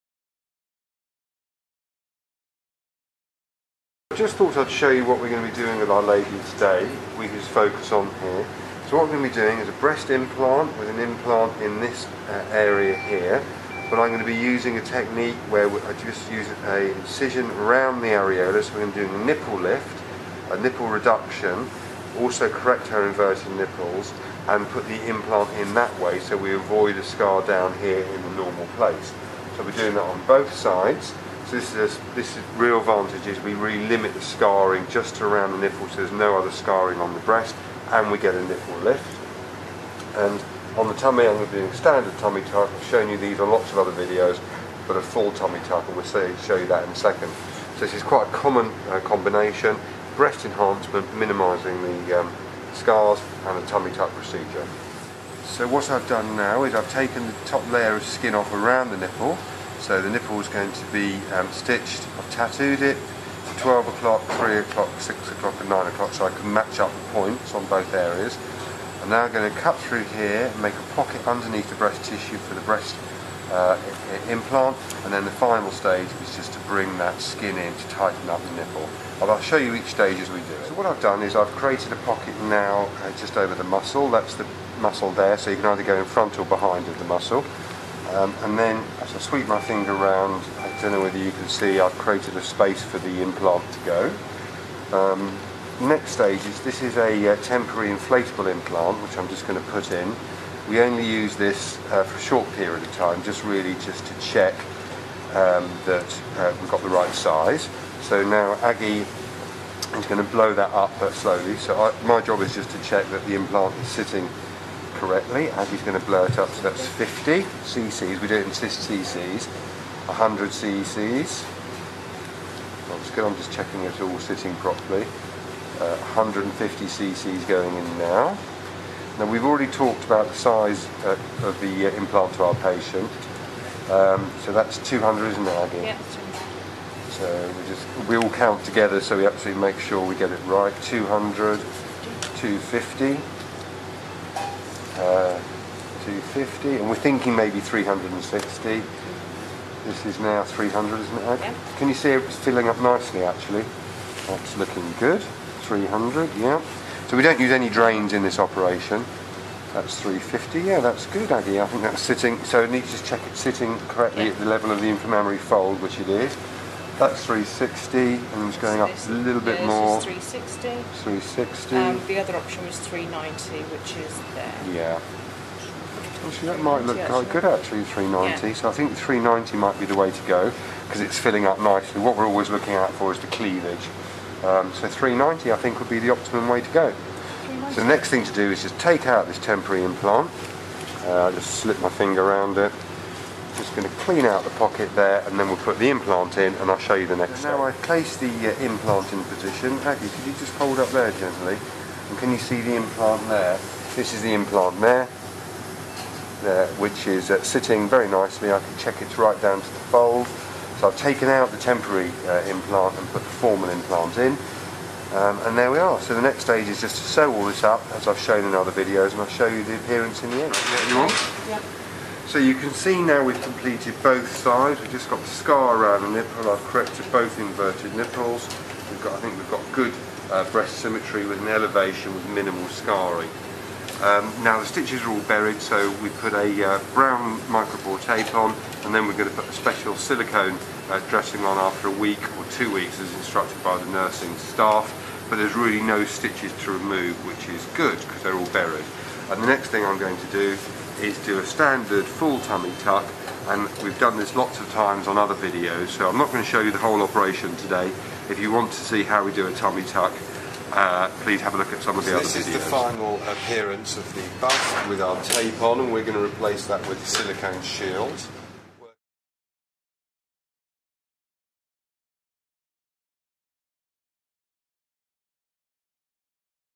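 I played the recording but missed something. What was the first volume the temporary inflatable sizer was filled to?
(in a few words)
50 cc.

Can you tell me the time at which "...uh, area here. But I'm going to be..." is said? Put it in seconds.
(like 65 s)
12 s.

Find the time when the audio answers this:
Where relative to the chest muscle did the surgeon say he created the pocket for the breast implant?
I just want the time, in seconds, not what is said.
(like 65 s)
83 s.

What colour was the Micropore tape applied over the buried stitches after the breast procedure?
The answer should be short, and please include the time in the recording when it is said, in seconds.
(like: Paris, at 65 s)
Brown, at 236 s.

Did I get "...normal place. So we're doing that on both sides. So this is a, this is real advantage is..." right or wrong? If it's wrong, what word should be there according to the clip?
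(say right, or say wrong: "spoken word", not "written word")
right.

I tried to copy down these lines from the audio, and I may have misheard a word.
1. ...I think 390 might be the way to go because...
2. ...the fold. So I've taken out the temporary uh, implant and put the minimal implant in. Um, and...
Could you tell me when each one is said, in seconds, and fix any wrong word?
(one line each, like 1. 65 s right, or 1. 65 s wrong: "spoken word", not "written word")
1. 178 s right
2. 209 s wrong: "formal", not "minimal".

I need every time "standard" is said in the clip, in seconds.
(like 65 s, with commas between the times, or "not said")
41 s, 251 s.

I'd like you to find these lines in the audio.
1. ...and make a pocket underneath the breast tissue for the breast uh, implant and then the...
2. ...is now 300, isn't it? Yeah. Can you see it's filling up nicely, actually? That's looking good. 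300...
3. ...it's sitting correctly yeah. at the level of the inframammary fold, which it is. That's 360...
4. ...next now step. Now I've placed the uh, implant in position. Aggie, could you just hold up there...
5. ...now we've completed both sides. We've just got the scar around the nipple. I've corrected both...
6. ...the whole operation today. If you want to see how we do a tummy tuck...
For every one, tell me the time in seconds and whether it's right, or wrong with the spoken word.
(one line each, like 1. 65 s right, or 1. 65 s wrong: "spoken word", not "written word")
1. 70 s right
2. 150 s right
3. 163 s right
4. 197 s right
5. 223 s right
6. 256 s right.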